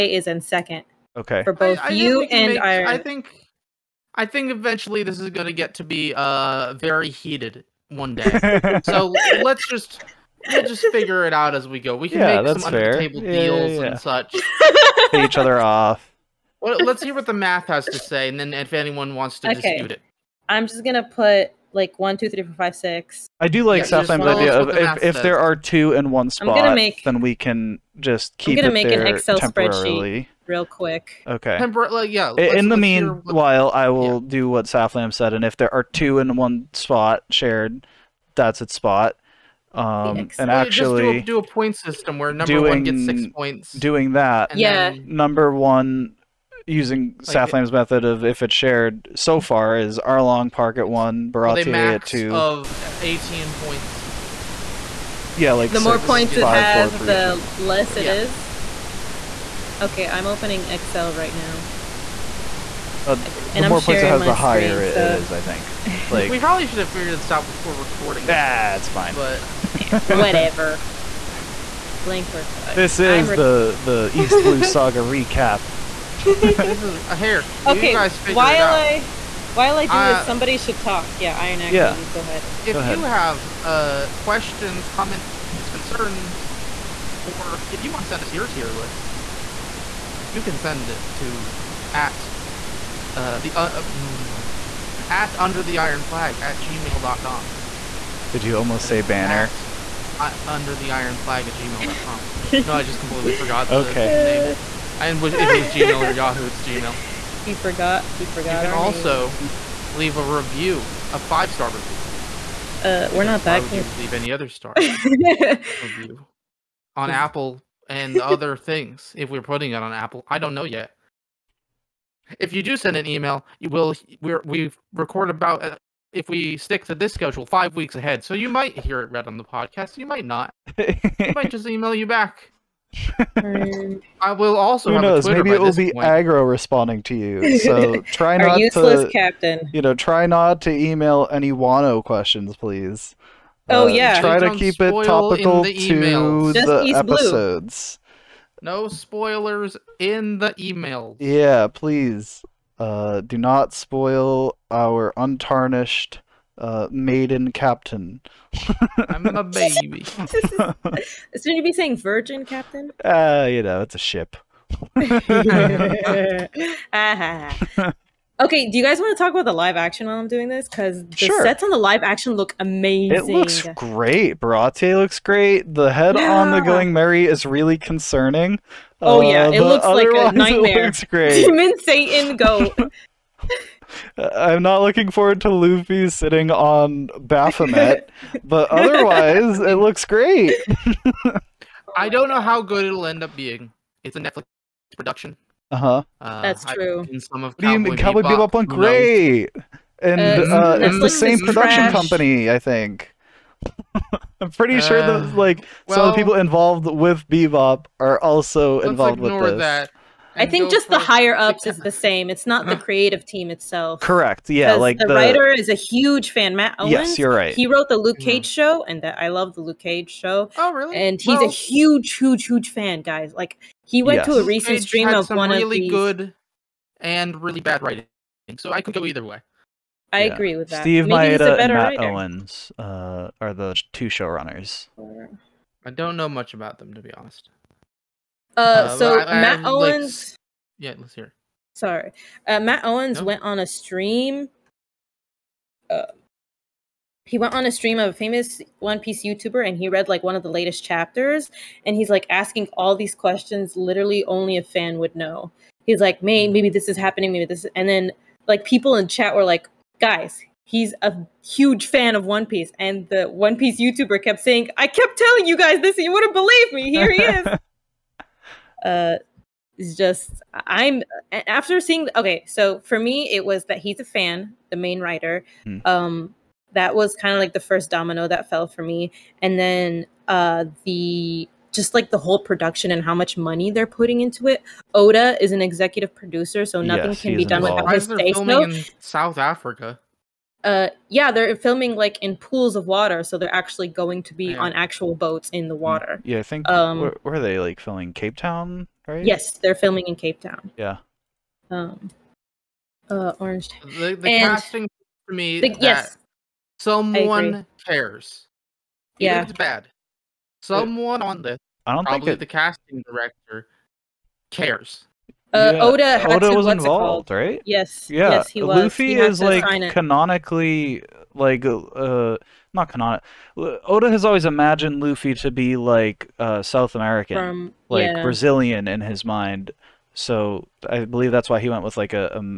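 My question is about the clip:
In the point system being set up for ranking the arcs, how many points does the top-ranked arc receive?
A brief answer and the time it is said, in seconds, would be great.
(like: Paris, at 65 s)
6, at 43 s.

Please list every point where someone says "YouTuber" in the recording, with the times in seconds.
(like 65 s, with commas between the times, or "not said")
249 s, 263 s.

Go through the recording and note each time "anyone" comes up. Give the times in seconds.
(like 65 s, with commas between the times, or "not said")
18 s.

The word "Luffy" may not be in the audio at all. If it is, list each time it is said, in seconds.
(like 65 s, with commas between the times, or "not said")
185 s, 318 s, 325 s.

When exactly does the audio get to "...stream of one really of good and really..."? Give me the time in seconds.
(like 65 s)
224 s.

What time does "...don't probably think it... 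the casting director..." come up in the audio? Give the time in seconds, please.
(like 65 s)
311 s.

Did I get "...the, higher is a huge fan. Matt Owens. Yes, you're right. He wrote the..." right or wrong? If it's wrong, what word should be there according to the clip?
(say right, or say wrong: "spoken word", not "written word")
wrong: "writer", not "higher".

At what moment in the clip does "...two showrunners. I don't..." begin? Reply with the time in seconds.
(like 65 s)
233 s.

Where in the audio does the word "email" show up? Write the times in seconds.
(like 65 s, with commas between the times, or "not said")
123 s, 131 s, 140 s, 150 s.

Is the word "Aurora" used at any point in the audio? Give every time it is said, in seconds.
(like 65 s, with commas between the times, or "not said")
not said.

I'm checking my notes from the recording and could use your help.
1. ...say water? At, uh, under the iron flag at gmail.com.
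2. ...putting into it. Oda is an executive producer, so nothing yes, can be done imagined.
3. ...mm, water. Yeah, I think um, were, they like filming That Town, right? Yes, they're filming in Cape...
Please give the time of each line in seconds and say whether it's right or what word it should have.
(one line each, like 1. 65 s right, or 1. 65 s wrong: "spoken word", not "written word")
1. 98 s wrong: "banner", not "water"
2. 283 s wrong: "involved", not "imagined"
3. 295 s wrong: "Cape", not "That".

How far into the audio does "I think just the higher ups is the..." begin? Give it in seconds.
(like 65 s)
210 s.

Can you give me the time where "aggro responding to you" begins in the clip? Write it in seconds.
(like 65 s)
136 s.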